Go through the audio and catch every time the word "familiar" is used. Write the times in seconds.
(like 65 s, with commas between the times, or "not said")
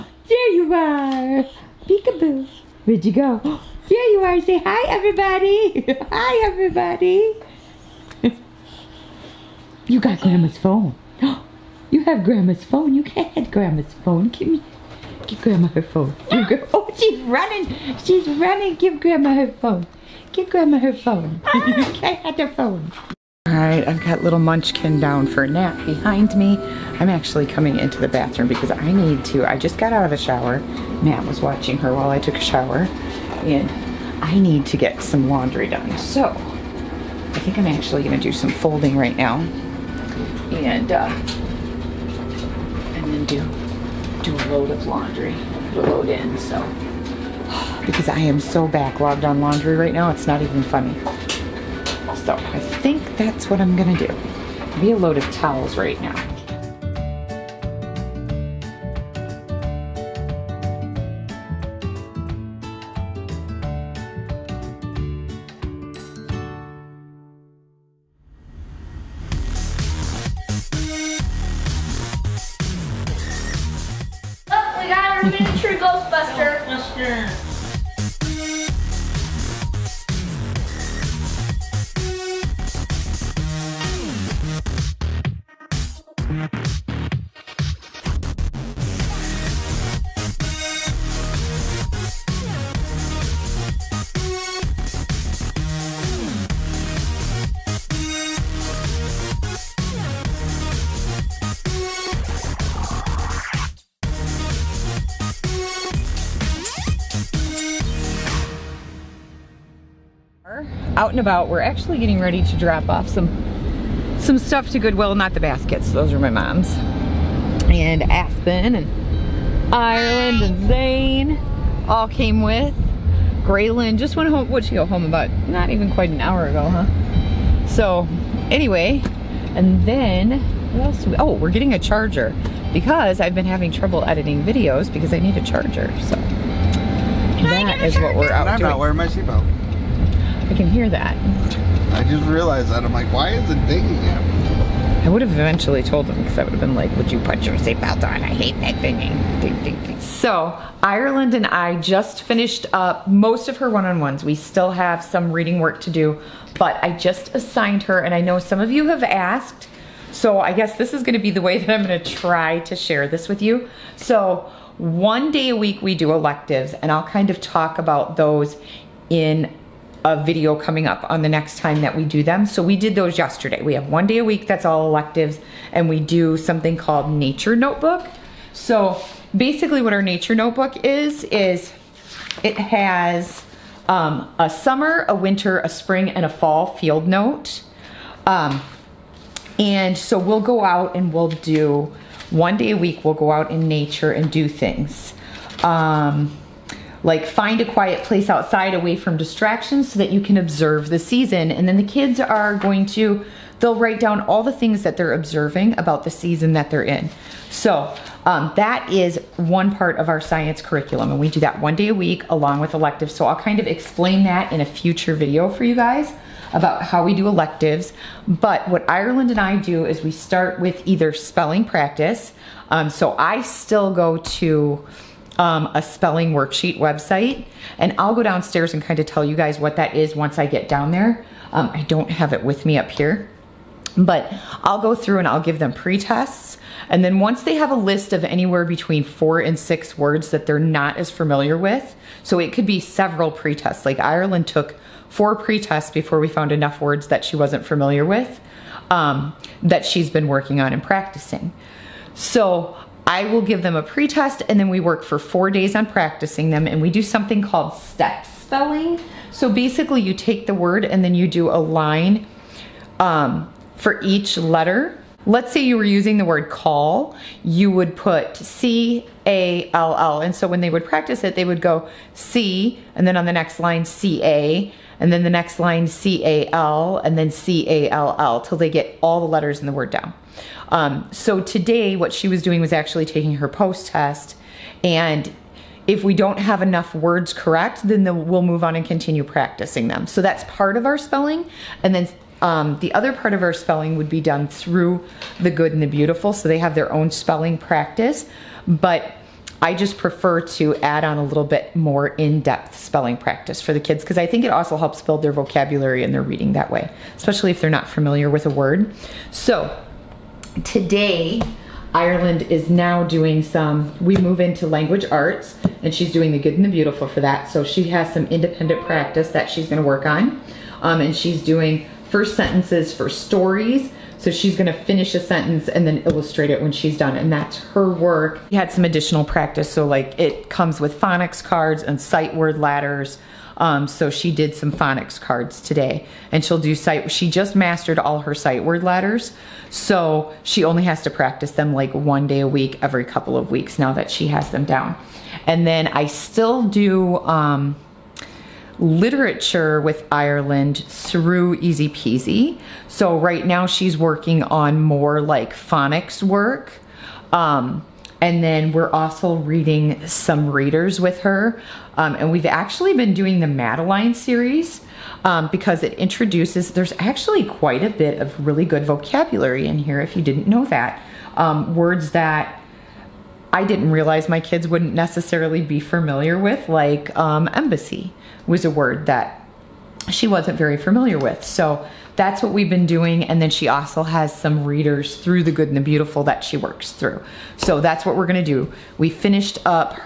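241 s, 247 s, 307 s, 375 s, 380 s.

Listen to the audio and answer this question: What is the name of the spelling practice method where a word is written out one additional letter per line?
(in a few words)
Step spelling.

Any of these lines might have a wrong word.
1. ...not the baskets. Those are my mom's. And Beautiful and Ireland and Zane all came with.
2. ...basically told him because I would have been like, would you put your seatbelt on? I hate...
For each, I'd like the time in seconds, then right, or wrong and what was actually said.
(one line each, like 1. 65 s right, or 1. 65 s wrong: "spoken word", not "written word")
1. 115 s wrong: "Aspen", not "Beautiful"
2. 145 s wrong: "eventually", not "basically".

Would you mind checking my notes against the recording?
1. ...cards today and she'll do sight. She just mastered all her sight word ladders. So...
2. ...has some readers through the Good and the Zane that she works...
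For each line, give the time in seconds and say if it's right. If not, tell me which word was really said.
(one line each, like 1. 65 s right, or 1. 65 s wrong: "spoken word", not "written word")
1. 335 s right
2. 384 s wrong: "Beautiful", not "Zane".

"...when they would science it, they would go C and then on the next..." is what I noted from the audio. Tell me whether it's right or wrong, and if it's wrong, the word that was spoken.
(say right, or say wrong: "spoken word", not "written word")
wrong: "practice", not "science".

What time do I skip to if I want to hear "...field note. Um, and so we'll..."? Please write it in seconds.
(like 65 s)
186 s.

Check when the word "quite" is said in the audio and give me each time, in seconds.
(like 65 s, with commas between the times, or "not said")
125 s, 367 s.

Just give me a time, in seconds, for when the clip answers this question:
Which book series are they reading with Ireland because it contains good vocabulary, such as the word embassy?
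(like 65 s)
363 s.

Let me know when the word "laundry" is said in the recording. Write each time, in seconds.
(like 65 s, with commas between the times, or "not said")
35 s, 44 s, 49 s.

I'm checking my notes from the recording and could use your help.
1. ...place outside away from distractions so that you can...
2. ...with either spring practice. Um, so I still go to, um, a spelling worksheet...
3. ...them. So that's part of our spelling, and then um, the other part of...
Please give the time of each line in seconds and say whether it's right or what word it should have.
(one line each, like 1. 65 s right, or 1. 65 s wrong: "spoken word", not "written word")
1. 198 s right
2. 220 s wrong: "spelling", not "spring"
3. 289 s right.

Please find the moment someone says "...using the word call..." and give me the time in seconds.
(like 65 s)
265 s.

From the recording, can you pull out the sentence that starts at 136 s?
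So that is what we're out I'm doing.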